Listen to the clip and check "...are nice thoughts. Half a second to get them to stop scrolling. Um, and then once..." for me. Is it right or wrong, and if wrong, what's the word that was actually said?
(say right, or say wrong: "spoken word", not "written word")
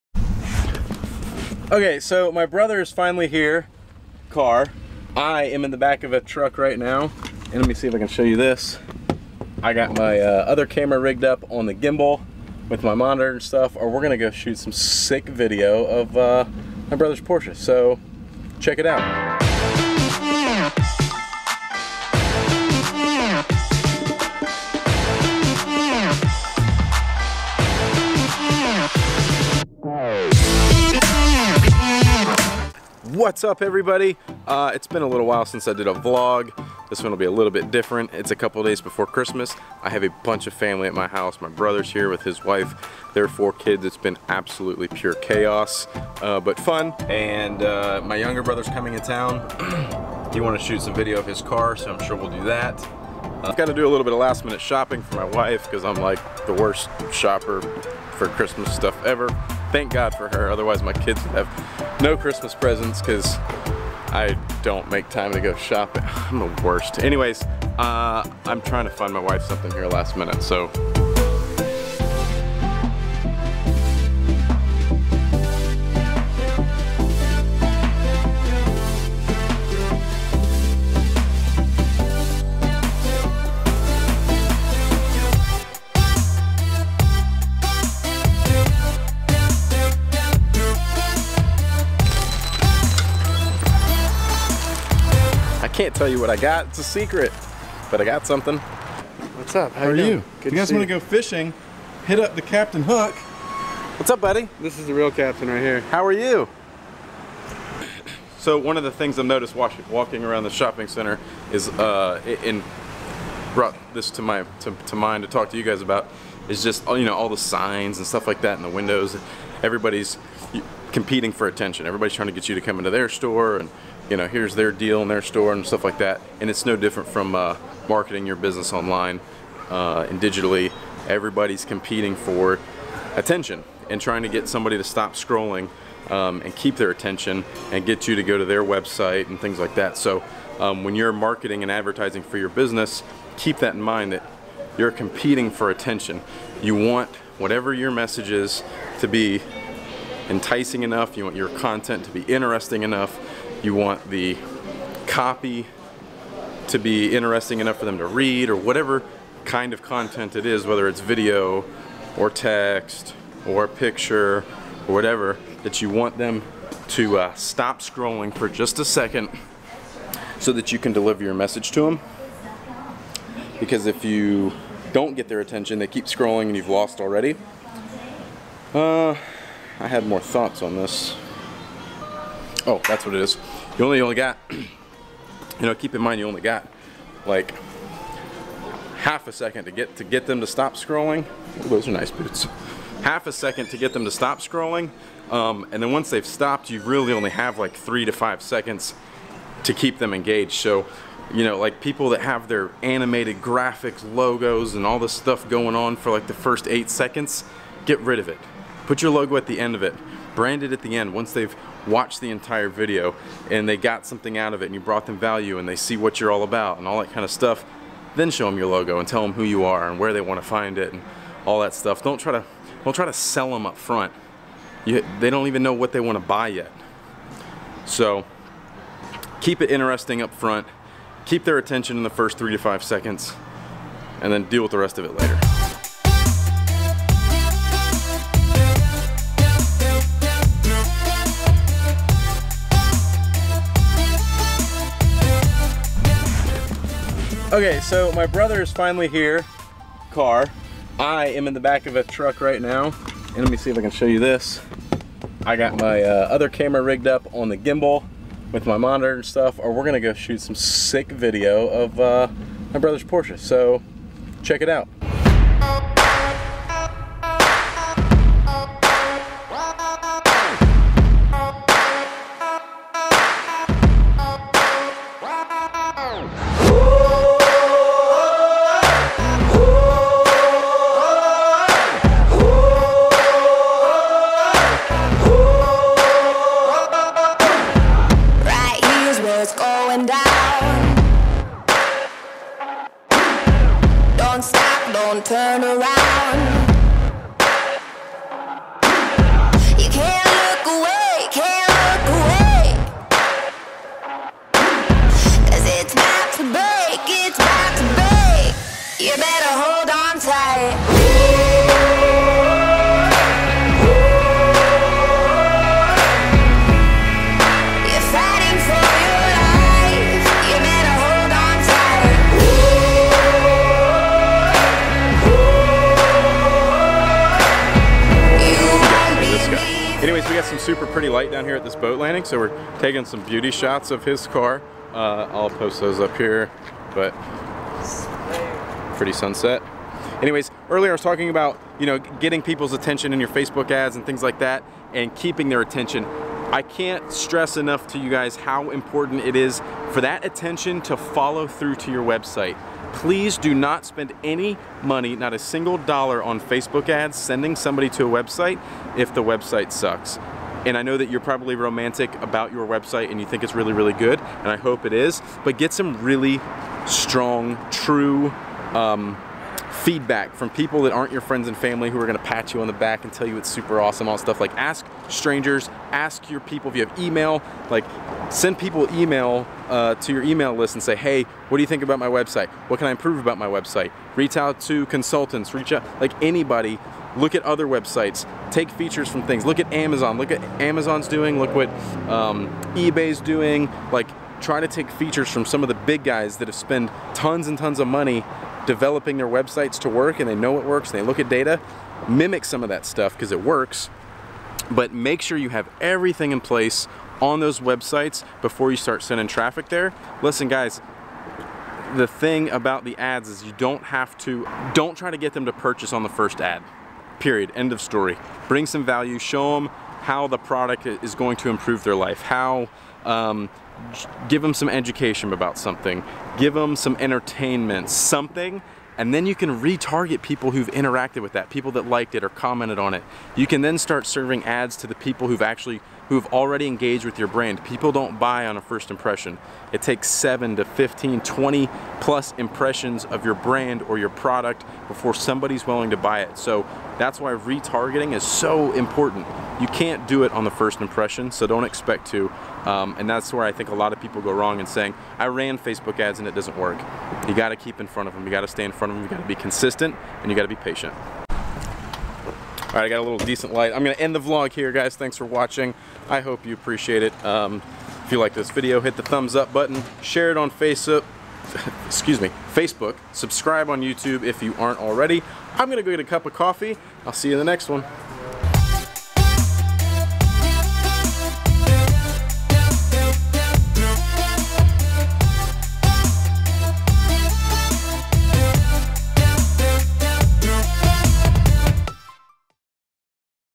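wrong: "boots", not "thoughts".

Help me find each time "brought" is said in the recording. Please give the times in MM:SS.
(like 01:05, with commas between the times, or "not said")
01:53, 03:34.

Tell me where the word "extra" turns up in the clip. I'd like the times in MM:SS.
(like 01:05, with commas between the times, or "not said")
not said.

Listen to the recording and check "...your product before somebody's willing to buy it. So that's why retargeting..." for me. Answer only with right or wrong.
right.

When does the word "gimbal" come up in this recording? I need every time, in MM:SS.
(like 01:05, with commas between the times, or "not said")
00:11, 04:17.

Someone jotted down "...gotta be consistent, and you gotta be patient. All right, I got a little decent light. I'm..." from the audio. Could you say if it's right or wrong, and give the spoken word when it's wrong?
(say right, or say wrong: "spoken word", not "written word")
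right.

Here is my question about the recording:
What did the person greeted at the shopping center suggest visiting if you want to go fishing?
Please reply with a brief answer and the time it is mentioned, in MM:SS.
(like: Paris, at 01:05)
the Captain Hook, at 01:42.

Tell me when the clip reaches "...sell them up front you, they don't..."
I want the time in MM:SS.
03:43.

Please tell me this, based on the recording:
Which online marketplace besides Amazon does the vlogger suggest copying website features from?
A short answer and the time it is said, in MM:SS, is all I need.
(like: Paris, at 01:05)
eBay, at 06:32.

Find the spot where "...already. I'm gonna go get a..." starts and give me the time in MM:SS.
07:54.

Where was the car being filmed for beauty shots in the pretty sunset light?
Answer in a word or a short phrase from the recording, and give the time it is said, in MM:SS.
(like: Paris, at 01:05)
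boat landing, at 05:31.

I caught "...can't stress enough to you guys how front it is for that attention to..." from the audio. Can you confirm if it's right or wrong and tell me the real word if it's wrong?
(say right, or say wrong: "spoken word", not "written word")
wrong: "important", not "front".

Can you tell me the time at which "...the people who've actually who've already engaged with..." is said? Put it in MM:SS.
07:14.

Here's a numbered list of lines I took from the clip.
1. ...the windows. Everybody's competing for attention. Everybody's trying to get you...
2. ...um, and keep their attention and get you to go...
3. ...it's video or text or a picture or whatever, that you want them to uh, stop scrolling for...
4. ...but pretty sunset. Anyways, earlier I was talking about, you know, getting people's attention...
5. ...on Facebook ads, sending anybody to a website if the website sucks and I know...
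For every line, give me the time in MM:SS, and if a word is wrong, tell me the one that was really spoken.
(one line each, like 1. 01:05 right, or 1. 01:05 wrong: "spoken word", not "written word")
1. 01:58 right
2. 02:16 right
3. 02:40 right
4. 05:36 right
5. 05:56 wrong: "somebody", not "anybody".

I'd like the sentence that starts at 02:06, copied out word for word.
And it's no different from uh, marketing your business online uh, and digitally.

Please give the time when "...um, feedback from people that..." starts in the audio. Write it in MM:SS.
06:08.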